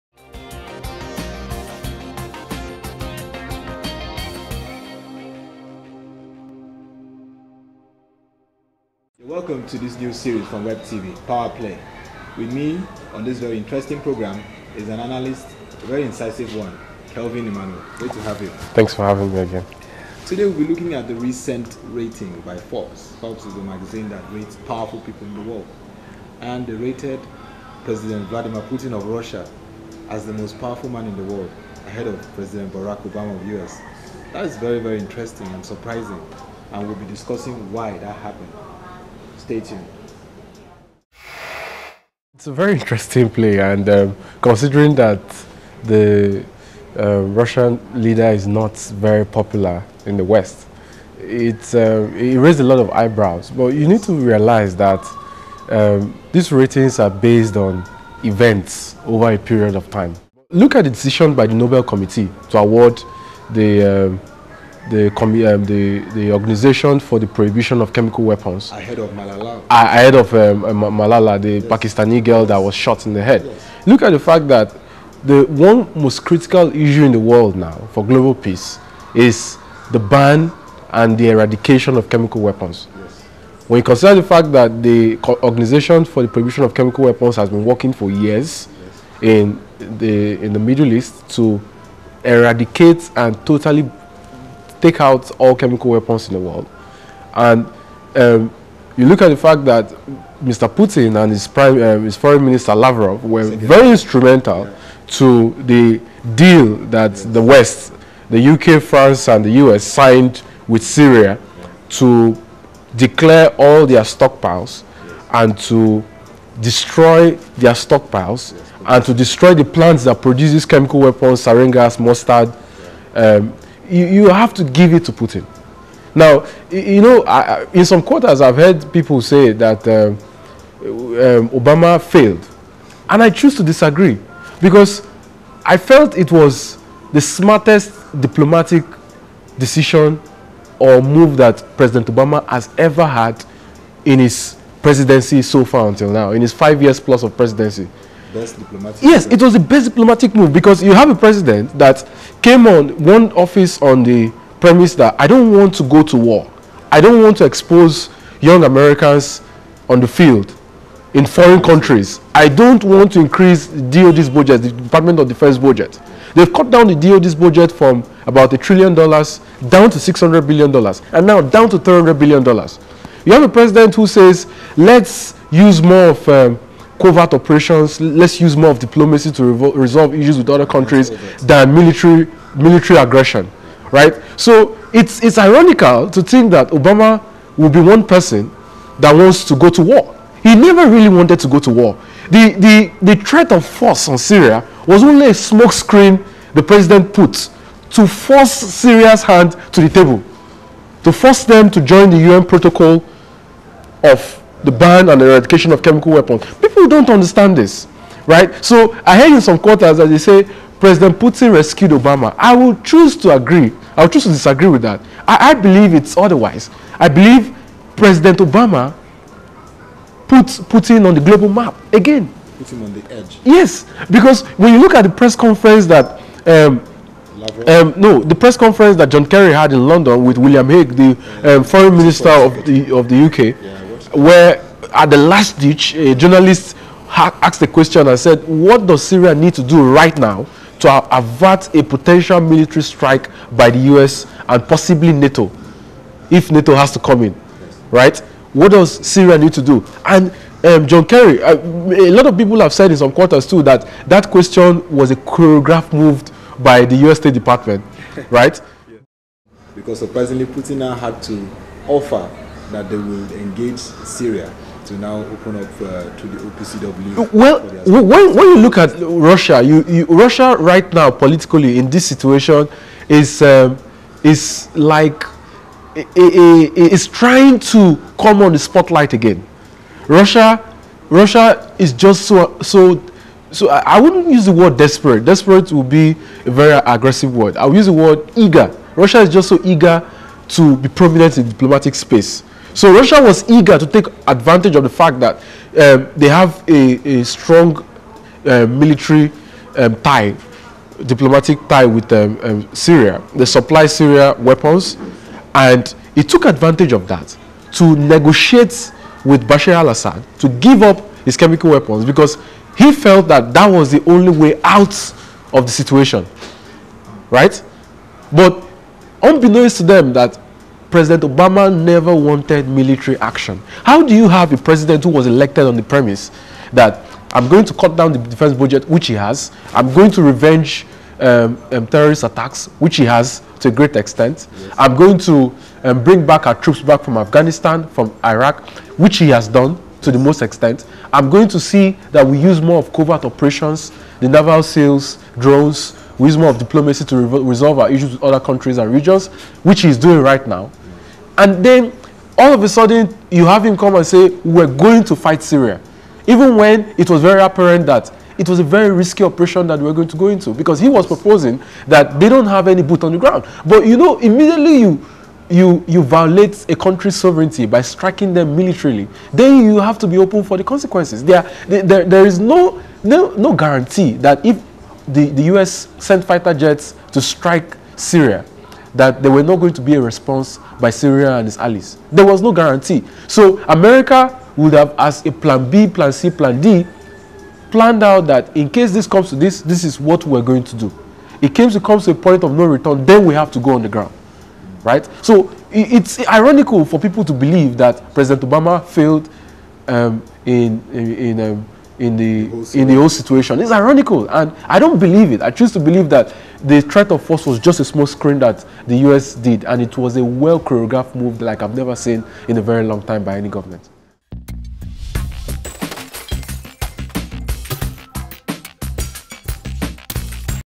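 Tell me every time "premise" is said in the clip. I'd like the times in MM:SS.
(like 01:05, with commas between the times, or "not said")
02:34, 05:25.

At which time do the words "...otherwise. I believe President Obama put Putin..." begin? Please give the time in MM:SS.
03:36.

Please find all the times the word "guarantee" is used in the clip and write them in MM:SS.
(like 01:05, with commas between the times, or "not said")
06:13, 06:22.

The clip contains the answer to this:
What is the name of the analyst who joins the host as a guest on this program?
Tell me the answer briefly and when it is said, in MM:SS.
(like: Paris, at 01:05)
Kelvin Emmanuel, at 00:17.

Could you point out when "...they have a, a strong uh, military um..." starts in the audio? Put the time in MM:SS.
04:56.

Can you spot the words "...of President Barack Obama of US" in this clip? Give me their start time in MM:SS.
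00:32.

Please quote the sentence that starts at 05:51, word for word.
And then all of a sudden, you have him come and say, We're going to fight Syria.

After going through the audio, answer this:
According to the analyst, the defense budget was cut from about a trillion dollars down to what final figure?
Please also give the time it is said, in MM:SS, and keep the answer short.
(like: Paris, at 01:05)
$300 billion, at 02:51.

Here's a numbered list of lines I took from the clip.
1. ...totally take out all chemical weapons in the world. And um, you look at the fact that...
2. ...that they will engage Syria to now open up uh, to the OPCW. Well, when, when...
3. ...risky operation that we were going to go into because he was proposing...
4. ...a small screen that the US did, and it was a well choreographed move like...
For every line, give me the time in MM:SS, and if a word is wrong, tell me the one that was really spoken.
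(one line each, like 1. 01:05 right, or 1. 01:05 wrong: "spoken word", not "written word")
1. 01:33 right
2. 04:22 right
3. 05:58 right
4. 06:47 right.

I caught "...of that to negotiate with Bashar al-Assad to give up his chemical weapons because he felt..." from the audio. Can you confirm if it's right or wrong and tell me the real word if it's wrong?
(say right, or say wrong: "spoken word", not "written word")
right.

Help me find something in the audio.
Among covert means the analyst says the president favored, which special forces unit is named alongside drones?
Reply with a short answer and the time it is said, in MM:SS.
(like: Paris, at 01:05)
the naval SEALs, at 05:44.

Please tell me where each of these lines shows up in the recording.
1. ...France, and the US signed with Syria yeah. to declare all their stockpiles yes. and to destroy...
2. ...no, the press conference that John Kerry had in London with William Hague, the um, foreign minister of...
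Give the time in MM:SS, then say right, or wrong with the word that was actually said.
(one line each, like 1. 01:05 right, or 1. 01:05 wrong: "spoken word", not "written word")
1. 01:48 right
2. 03:47 right.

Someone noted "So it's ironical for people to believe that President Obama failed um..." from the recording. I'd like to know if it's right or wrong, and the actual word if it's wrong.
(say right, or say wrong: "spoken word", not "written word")
right.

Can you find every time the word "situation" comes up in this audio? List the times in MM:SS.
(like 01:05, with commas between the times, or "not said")
04:32, 05:15, 06:43.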